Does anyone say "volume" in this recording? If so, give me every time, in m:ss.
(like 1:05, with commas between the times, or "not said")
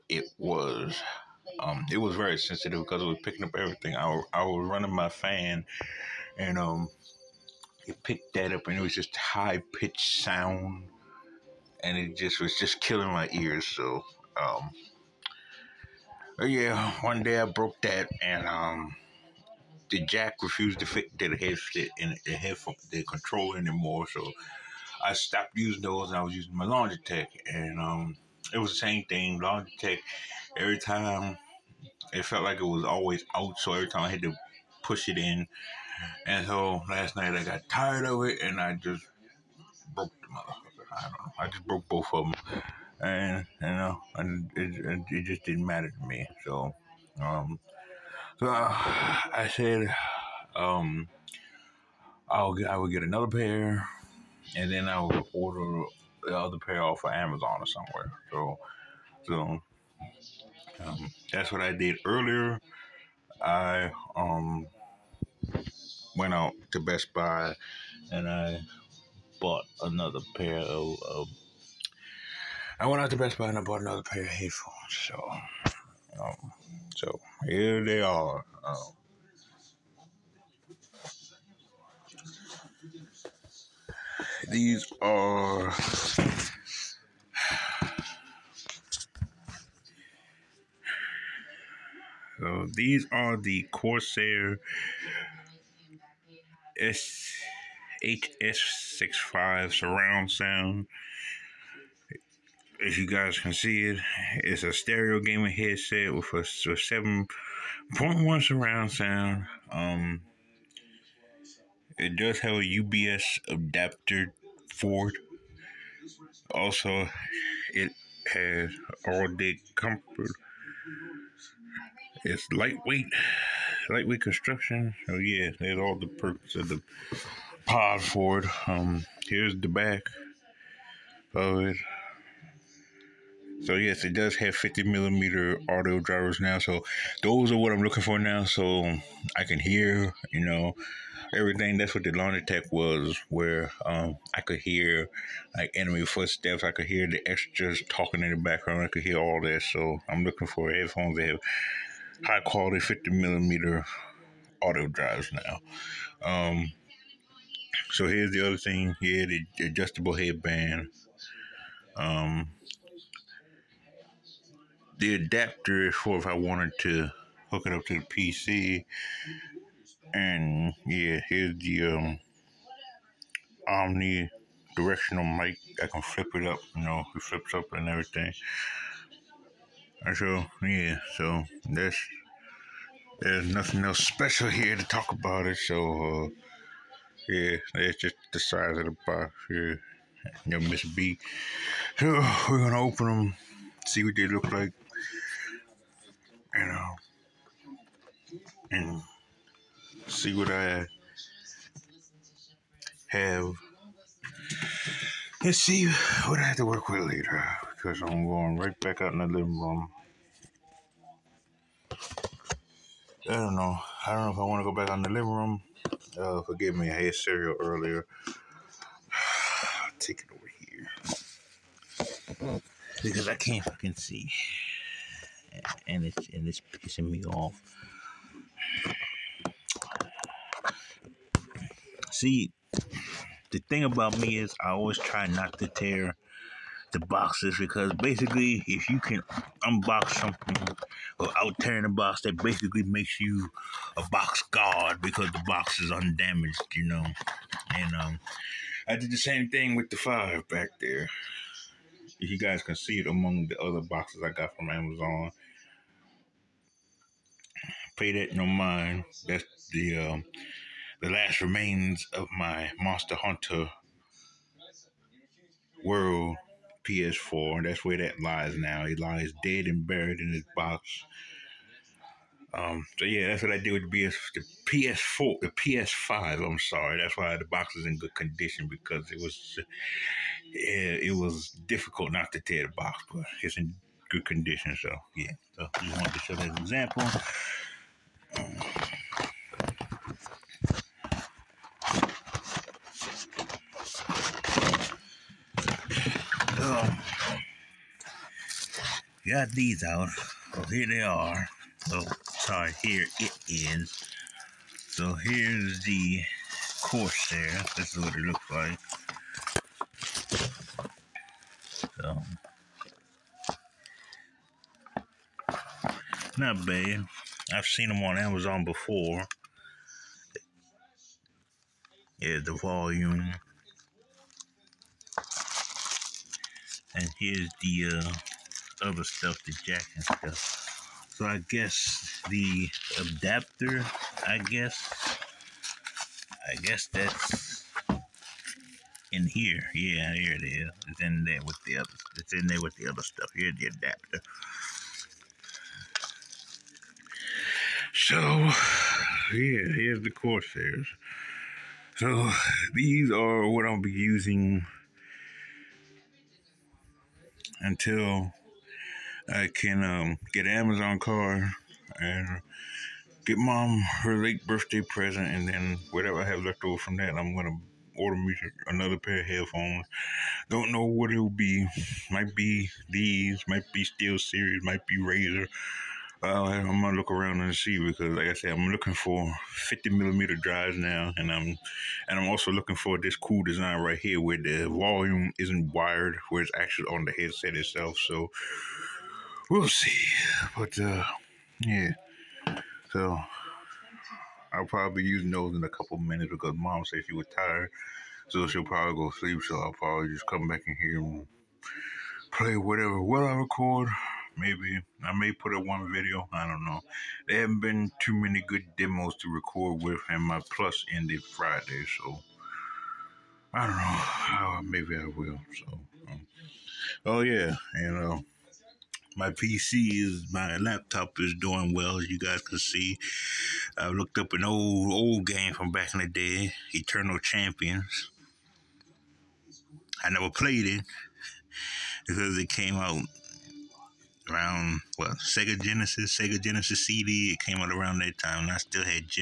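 5:22, 6:24.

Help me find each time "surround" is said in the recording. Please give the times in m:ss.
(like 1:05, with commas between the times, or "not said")
1:39, 1:48.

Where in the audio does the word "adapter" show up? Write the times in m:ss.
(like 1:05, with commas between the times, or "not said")
1:53, 2:45, 5:32, 5:43.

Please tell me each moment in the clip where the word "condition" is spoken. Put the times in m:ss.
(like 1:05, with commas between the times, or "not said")
4:38, 4:44.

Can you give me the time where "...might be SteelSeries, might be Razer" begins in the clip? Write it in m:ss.
6:13.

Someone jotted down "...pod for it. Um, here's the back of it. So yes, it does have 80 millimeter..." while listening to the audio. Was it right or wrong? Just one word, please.
wrong.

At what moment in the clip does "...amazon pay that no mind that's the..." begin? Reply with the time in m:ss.
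4:14.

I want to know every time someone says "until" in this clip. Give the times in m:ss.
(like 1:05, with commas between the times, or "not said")
5:57.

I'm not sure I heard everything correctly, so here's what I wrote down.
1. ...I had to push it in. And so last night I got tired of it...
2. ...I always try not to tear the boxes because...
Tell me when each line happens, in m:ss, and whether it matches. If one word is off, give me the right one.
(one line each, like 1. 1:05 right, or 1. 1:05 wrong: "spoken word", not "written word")
1. 0:34 right
2. 3:54 right.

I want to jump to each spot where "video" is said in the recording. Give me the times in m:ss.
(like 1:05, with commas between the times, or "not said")
6:45.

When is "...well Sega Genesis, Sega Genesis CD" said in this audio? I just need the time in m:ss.
7:14.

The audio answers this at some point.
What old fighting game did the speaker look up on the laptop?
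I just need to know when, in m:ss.
7:06.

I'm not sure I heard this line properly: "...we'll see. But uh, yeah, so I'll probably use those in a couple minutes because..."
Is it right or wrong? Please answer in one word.
right.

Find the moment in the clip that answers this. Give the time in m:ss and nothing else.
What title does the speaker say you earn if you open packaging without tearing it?
4:04.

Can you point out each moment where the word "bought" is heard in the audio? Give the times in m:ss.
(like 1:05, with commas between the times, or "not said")
1:09, 1:13.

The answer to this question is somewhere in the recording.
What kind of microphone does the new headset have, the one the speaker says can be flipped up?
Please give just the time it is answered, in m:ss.
2:53.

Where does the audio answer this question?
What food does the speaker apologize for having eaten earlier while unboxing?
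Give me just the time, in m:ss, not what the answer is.
3:37.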